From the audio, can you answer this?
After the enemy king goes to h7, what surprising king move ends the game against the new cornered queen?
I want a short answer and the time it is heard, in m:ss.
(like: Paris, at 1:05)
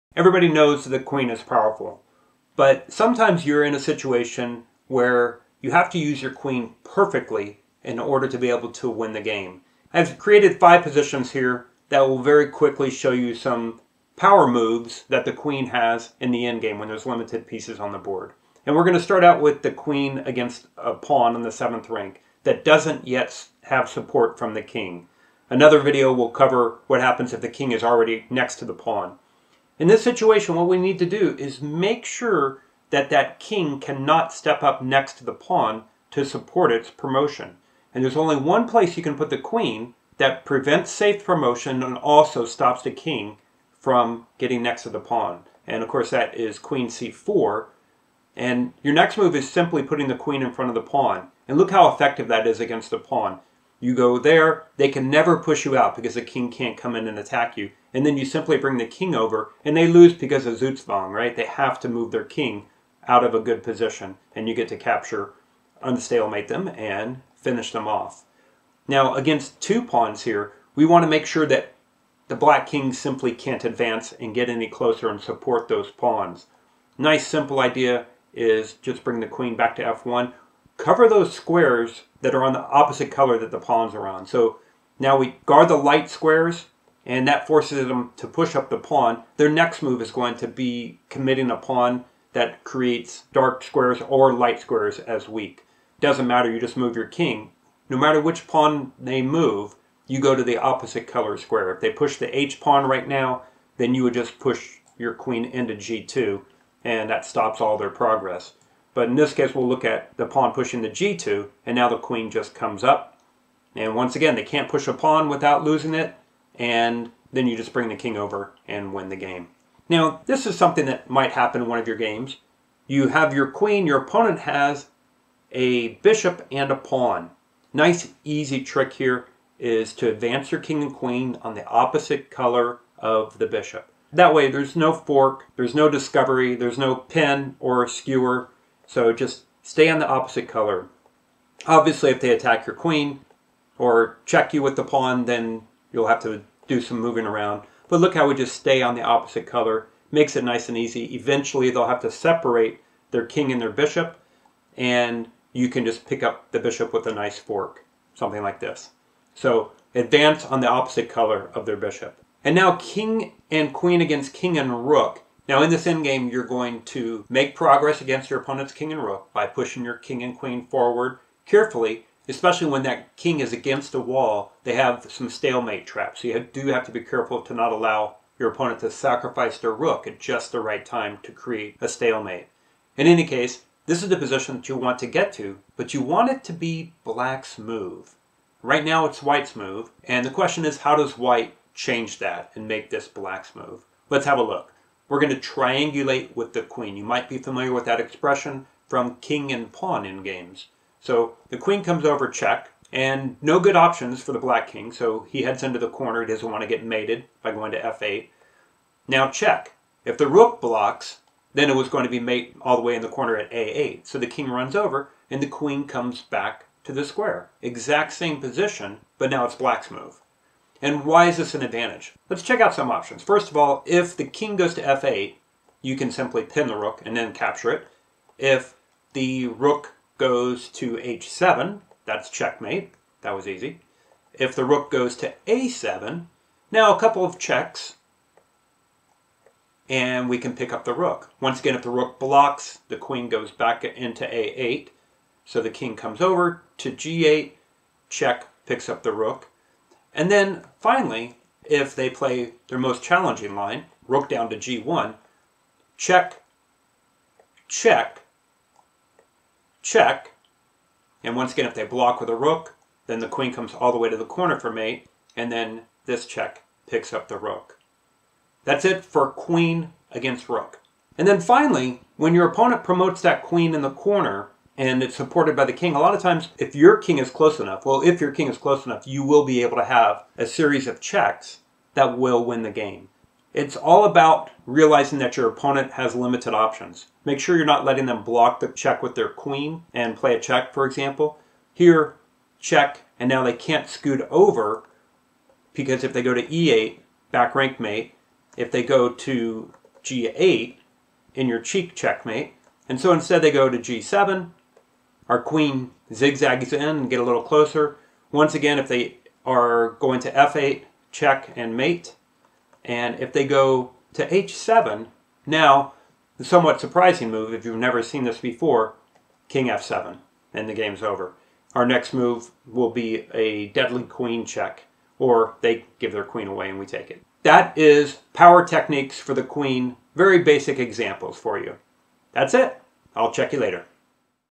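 King f7, at 5:19.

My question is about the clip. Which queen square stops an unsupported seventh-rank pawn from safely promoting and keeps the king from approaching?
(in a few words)
Queen c4.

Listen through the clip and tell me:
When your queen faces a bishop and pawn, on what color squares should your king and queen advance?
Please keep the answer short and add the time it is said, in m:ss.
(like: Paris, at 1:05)
Opposite color of the bishop, at 2:11.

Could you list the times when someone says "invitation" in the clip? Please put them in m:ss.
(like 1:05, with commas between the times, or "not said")
not said.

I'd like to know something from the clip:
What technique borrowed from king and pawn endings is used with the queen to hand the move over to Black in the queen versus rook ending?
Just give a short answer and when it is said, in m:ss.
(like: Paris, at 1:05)
Triangulate, at 3:15.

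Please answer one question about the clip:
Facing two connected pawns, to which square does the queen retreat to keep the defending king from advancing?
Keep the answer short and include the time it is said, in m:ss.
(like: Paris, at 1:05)
f1, at 1:19.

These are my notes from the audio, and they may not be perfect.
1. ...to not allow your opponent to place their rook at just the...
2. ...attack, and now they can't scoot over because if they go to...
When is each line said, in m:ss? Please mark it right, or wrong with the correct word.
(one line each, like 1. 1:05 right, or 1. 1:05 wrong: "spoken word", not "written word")
1. 2:57 wrong: "sacrifice", not "place"
2. 4:52 wrong: "check", not "attack".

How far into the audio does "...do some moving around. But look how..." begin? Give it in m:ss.
2:26.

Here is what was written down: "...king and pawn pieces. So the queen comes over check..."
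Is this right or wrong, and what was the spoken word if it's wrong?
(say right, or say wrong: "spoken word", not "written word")
wrong: "endgames", not "pieces".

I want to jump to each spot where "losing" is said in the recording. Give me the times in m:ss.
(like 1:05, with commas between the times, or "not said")
1:55.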